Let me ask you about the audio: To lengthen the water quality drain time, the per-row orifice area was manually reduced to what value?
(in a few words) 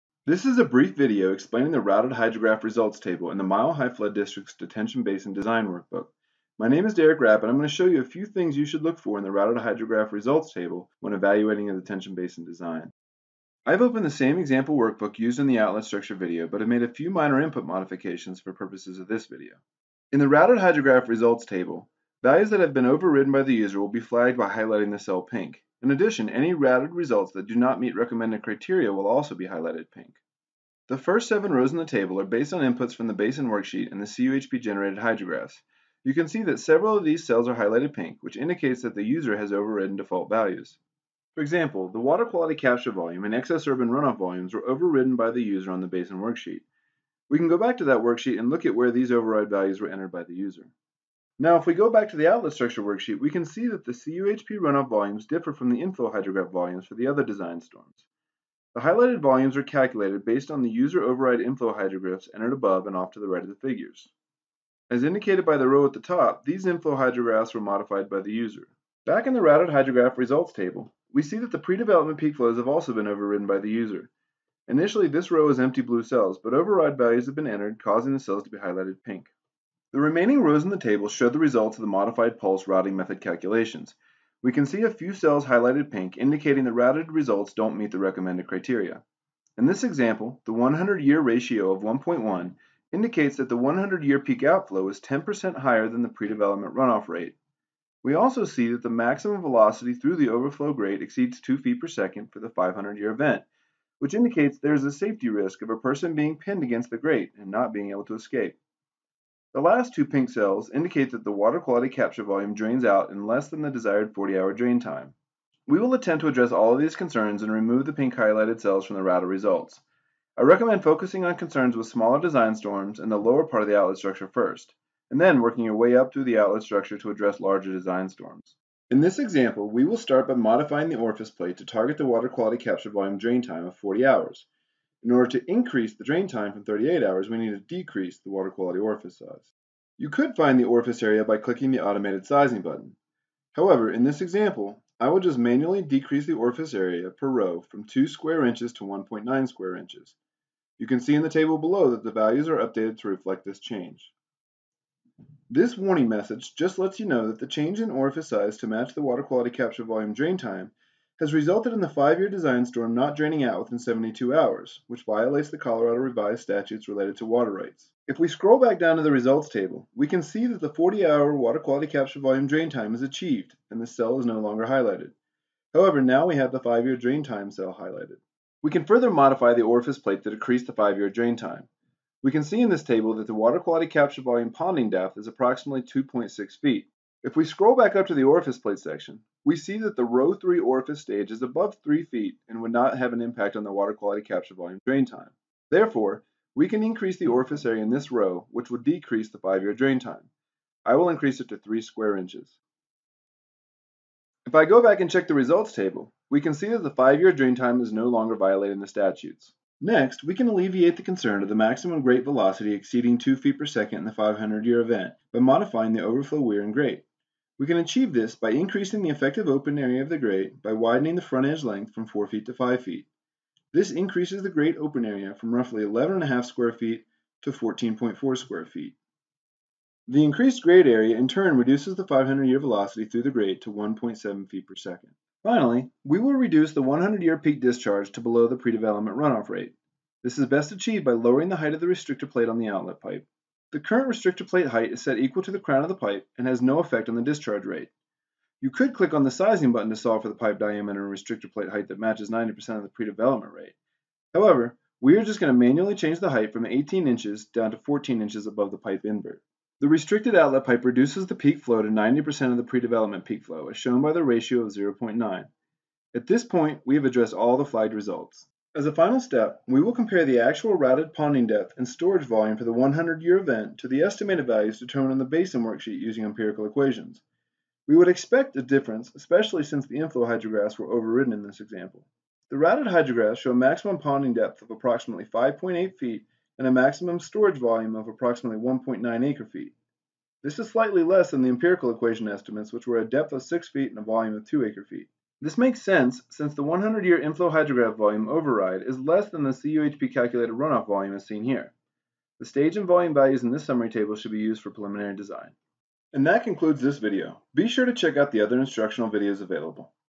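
1.9 square inches.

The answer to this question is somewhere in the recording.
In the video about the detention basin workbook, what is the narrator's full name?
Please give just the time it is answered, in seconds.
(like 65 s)
6 s.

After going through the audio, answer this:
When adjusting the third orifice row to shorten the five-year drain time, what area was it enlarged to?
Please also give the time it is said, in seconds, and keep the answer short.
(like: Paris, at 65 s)
3 square inches, at 201 s.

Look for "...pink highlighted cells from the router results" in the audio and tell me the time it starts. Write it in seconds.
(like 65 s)
117 s.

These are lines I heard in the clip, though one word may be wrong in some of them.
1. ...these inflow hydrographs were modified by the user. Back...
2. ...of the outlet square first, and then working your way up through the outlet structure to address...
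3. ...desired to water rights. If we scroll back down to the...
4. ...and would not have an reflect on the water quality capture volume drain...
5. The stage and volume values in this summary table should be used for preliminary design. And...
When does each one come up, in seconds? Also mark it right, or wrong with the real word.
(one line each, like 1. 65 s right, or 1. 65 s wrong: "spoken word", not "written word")
1. 66 s right
2. 123 s wrong: "structure", not "square"
3. 166 s wrong: "related", not "desired"
4. 192 s wrong: "impact", not "reflect"
5. 302 s right.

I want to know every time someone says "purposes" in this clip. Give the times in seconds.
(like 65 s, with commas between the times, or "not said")
18 s.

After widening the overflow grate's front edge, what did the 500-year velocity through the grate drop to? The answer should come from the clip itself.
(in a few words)
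1.7 feet per second.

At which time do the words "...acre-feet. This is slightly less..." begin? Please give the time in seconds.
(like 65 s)
289 s.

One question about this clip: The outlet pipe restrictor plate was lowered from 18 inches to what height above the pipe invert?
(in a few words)
14 inches.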